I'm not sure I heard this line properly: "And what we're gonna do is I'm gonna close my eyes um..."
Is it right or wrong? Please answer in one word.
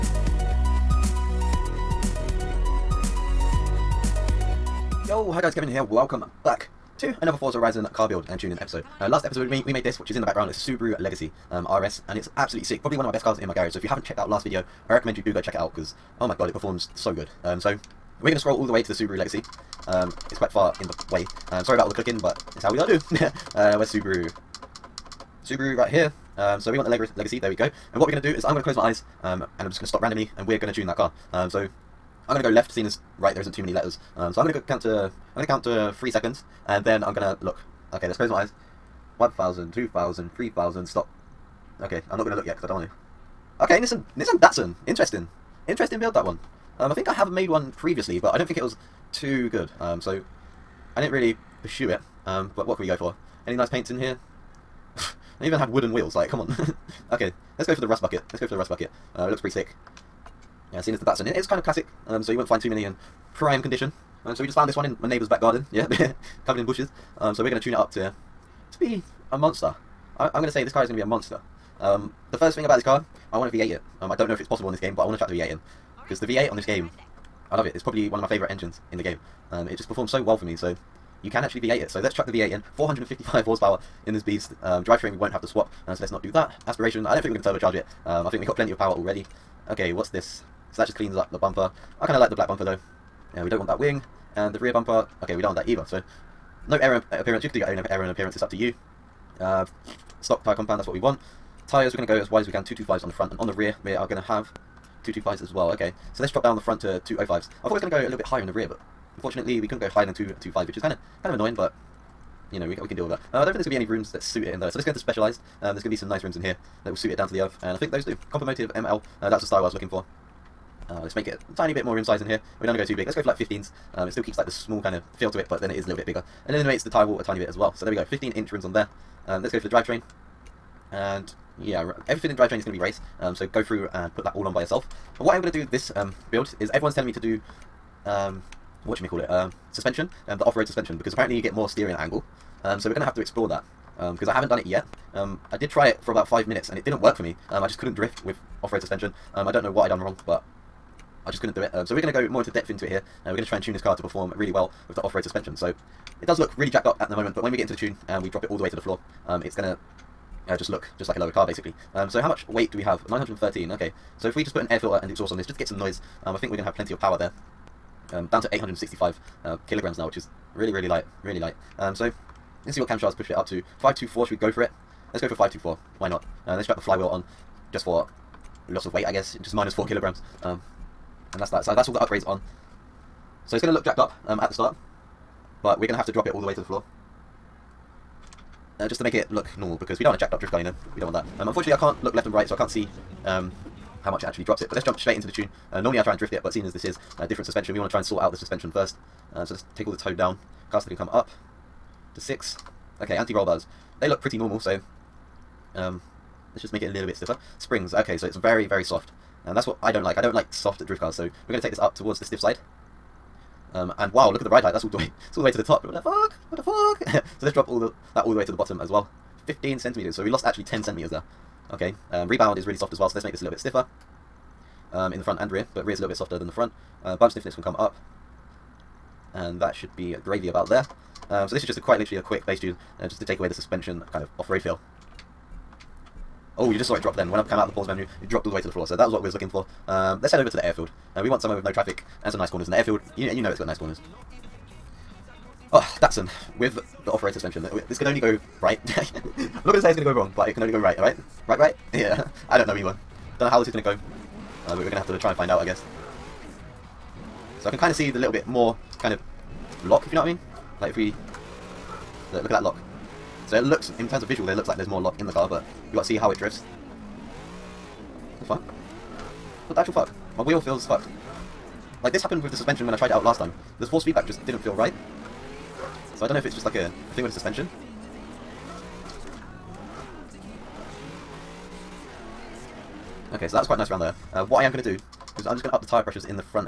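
right.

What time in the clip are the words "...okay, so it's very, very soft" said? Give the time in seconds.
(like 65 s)
207 s.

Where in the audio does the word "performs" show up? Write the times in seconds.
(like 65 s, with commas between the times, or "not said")
16 s, 79 s, 154 s.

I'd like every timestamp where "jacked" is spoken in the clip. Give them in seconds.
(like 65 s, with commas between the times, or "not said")
156 s, 183 s, 190 s.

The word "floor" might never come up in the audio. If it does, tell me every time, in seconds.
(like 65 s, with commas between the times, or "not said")
158 s, 186 s, 238 s.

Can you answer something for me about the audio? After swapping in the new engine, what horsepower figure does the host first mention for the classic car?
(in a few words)
455.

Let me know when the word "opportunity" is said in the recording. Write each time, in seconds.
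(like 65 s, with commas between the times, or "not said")
not said.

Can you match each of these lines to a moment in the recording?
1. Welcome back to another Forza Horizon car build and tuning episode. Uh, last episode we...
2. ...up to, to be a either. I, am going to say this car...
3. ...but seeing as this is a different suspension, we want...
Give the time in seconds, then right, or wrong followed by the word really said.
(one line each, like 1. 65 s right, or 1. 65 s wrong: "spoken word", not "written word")
1. 5 s right
2. 67 s wrong: "monster", not "either"
3. 196 s right.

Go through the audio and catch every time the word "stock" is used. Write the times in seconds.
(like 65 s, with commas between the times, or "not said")
100 s.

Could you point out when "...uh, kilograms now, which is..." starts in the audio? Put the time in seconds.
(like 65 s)
169 s.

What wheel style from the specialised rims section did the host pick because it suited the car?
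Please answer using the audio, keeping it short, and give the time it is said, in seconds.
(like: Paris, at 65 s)
Compomotive ML, at 118 s.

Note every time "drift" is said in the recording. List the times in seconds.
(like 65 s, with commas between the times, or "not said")
147 s, 190 s, 196 s, 210 s, 266 s.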